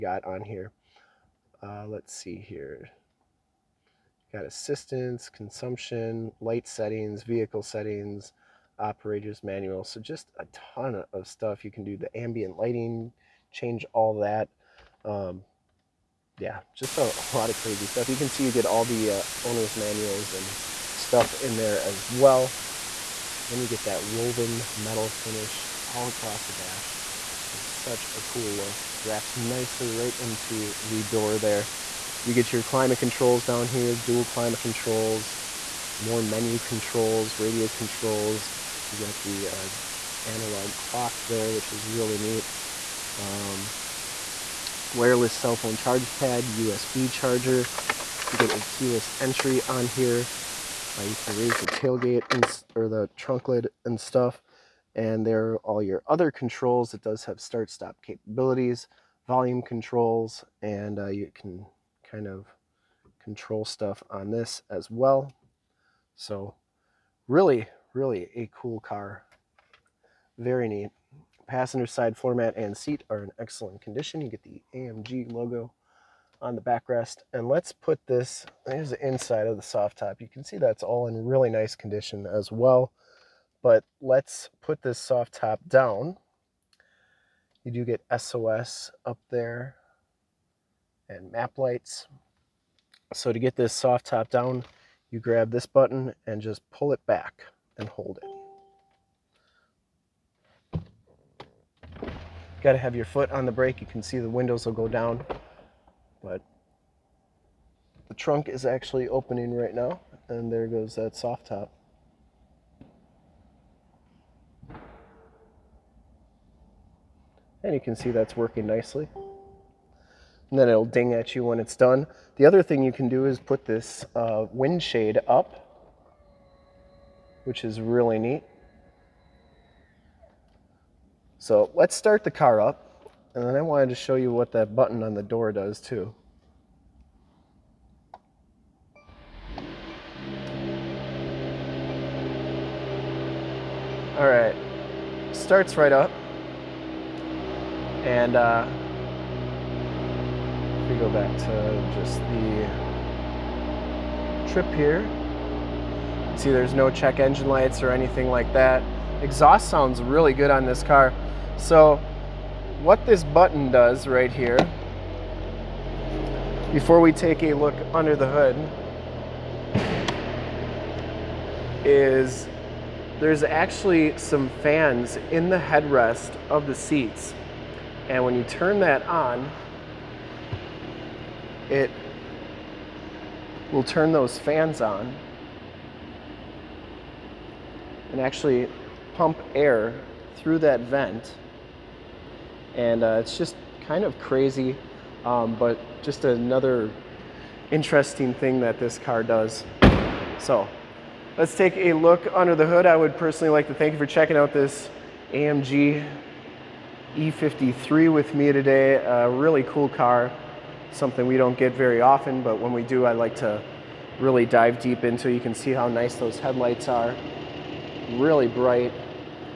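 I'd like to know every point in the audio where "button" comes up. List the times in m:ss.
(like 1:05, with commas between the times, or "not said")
1:35, 2:14, 2:43.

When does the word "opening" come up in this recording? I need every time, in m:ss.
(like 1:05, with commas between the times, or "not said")
1:49.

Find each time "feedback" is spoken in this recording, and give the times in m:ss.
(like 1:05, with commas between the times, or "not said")
not said.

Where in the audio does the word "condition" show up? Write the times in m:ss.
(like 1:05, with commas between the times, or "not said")
1:13, 1:21.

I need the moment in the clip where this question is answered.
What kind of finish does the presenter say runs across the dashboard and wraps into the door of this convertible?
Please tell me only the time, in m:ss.
0:24.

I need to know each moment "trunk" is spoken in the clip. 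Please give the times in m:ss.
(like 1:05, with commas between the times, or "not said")
0:53, 1:48.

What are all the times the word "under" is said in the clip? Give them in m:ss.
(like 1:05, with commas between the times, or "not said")
2:47, 3:22.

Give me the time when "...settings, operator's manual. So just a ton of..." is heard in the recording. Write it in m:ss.
0:07.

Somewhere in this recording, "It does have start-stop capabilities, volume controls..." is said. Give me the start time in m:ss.
0:56.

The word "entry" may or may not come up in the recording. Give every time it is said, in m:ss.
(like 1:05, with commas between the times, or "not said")
0:49.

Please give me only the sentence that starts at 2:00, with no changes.
And then it'll ding at you when it's done.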